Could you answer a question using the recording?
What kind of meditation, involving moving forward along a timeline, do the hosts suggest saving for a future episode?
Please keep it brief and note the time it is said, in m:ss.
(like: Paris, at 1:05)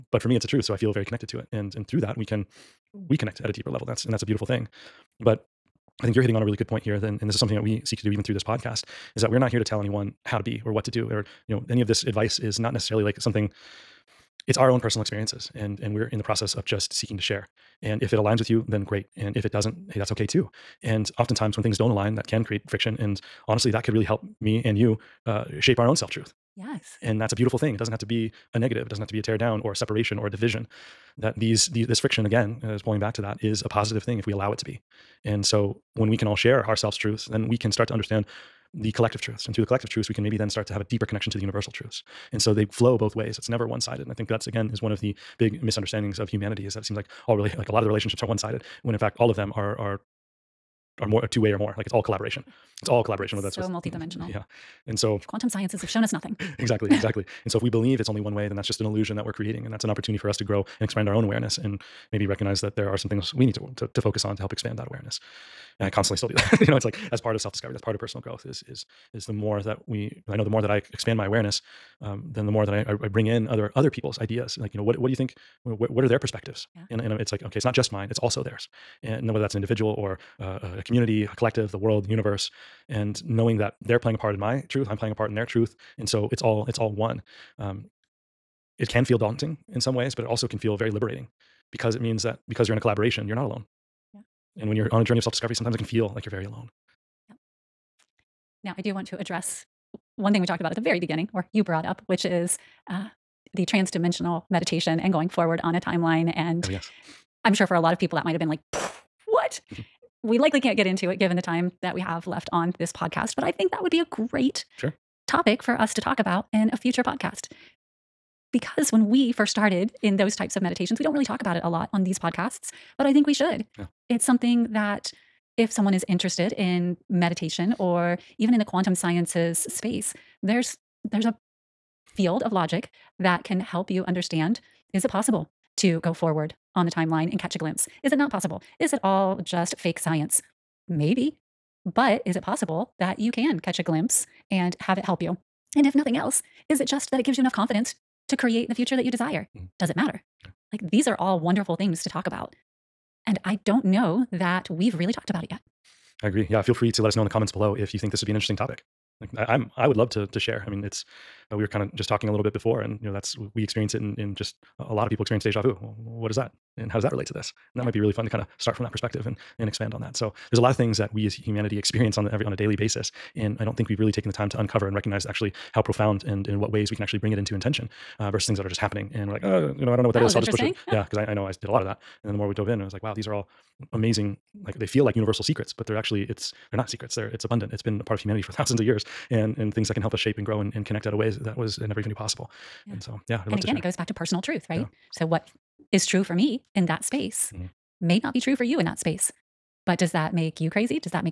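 transdimensional meditation, at 1:43.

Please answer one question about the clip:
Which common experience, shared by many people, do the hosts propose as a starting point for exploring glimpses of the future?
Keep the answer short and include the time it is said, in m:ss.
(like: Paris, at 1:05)
deja vu, at 2:45.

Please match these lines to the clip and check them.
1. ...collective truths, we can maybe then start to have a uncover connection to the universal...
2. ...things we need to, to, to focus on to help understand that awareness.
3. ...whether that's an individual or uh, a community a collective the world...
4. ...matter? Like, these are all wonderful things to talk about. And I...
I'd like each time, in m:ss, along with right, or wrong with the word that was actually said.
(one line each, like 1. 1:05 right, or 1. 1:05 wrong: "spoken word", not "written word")
1. 0:39 wrong: "deeper", not "uncover"
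2. 1:03 wrong: "expand", not "understand"
3. 1:19 right
4. 2:29 right.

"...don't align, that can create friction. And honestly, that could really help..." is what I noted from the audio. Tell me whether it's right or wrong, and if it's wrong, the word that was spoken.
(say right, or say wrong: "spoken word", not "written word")
right.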